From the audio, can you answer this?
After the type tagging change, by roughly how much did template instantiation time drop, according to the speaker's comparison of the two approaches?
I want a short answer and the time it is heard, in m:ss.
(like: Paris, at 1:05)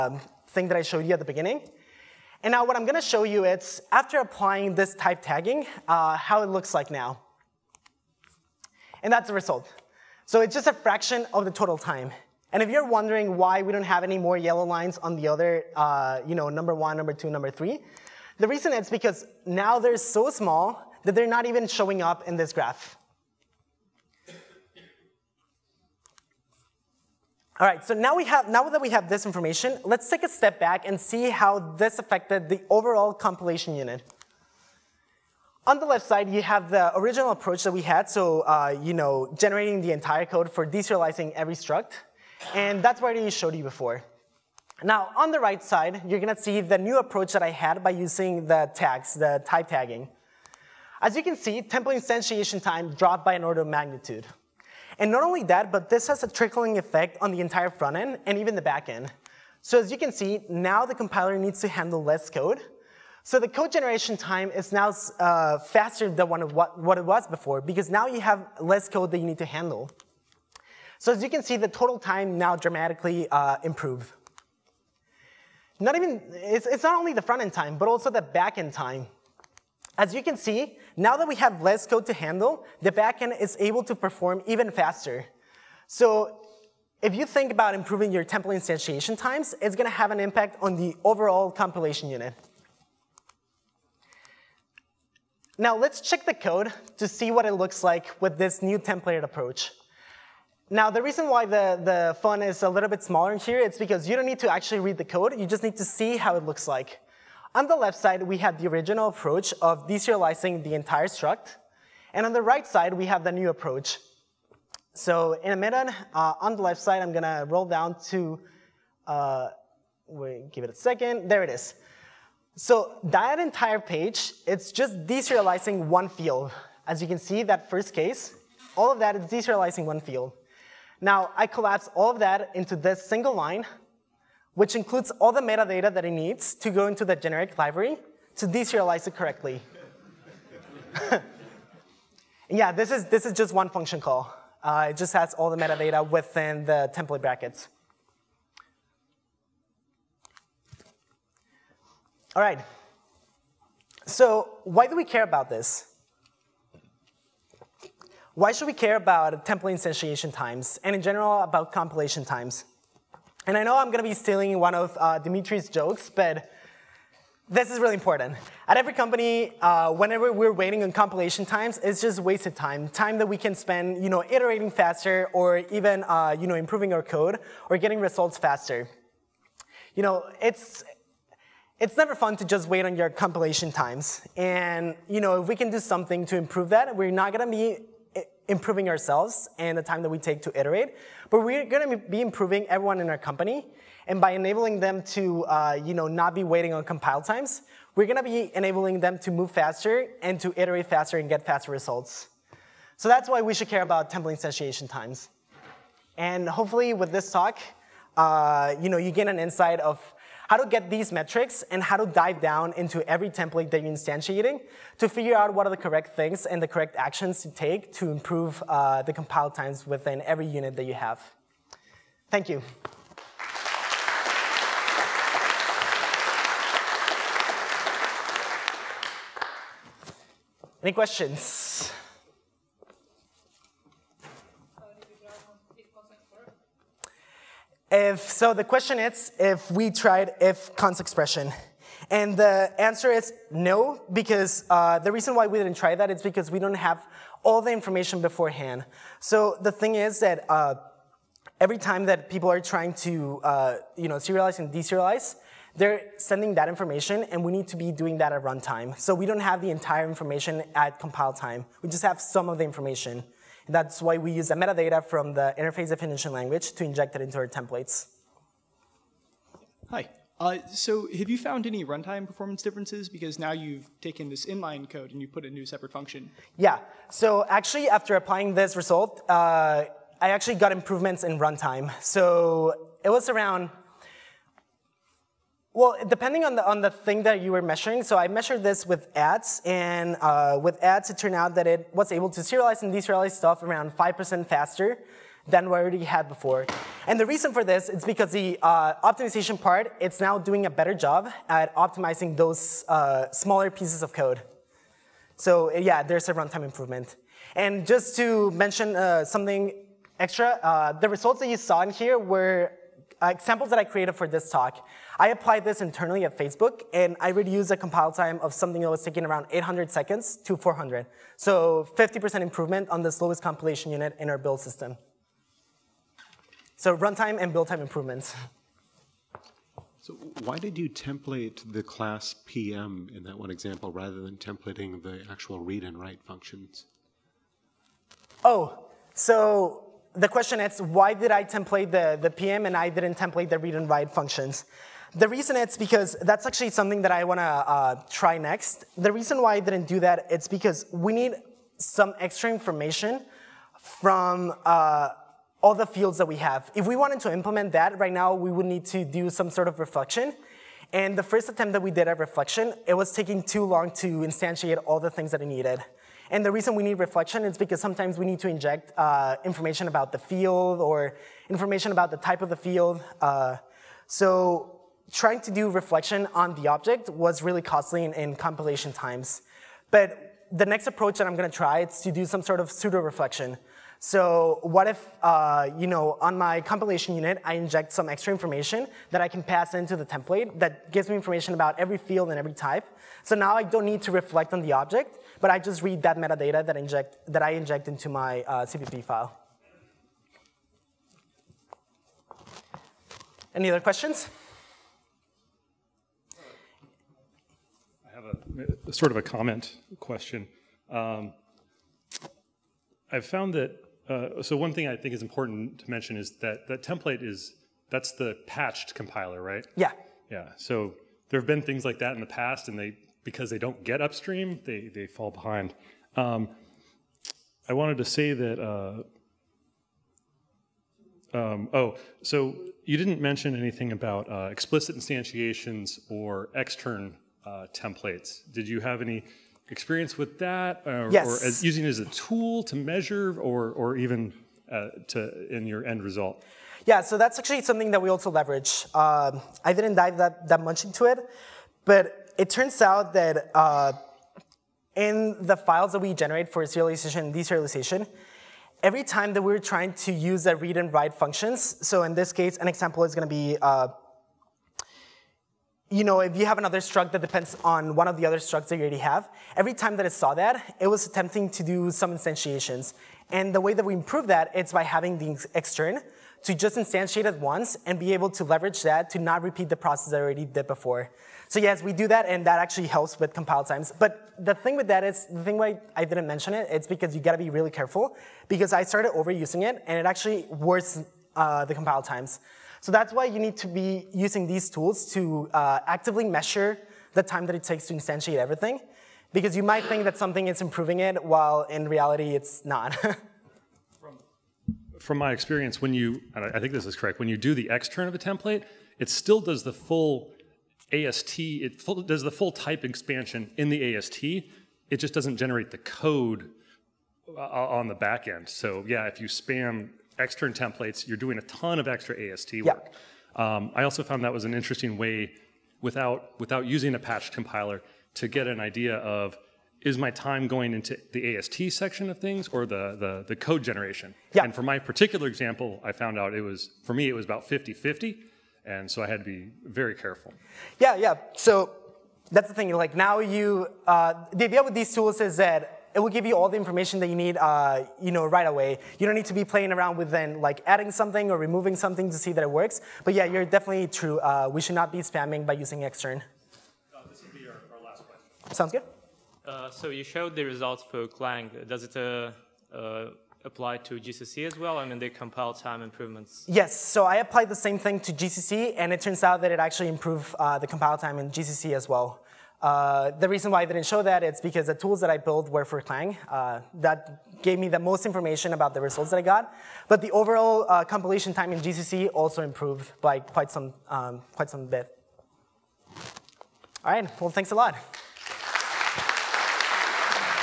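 An order of magnitude, at 0:53.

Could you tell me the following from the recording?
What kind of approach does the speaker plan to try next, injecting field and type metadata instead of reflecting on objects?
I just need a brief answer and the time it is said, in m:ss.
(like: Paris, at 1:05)
Pseudo-reflection, at 6:22.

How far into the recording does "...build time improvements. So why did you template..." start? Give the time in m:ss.
5:27.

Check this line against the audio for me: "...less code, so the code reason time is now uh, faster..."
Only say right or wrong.
wrong.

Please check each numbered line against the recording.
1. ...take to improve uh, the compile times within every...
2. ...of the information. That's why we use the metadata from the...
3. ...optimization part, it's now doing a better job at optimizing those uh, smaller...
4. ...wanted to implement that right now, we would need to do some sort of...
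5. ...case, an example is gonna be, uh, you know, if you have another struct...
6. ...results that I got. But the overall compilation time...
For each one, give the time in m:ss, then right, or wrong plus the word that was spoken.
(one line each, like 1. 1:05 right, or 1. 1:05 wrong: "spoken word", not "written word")
1. 3:37 right
2. 4:22 right
3. 4:58 right
4. 5:56 right
5. 7:42 right
6. 9:38 right.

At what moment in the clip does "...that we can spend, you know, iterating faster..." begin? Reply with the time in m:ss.
2:53.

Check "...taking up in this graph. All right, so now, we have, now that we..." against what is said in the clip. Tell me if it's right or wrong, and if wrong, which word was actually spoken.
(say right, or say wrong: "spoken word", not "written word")
wrong: "showing", not "taking".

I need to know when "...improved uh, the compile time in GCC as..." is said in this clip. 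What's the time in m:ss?
9:29.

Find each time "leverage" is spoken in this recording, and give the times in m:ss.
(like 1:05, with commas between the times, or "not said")
7:28, 7:58.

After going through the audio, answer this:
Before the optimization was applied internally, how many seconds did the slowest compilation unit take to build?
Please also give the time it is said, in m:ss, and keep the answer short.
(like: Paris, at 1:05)
800 seconds, at 5:19.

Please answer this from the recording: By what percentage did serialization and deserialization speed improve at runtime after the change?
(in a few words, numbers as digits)
5%.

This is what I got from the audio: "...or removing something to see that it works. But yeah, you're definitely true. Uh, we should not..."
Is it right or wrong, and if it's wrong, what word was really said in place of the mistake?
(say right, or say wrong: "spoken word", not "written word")
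right.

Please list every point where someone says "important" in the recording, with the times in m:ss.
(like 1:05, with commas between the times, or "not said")
2:47, 6:55.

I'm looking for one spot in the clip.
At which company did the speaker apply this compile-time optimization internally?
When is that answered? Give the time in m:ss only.
5:16.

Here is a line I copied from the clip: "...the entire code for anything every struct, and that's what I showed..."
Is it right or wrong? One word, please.
wrong.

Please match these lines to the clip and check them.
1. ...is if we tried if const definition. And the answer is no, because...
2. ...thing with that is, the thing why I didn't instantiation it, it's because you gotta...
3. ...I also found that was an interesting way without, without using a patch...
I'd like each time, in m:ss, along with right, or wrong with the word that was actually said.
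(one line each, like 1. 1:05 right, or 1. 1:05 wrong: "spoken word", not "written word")
1. 3:58 wrong: "expression", not "definition"
2. 8:04 wrong: "mention", not "instantiation"
3. 8:43 right.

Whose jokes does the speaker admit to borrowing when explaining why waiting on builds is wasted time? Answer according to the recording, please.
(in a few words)
Dimitri.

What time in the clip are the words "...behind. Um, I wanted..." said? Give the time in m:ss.
7:05.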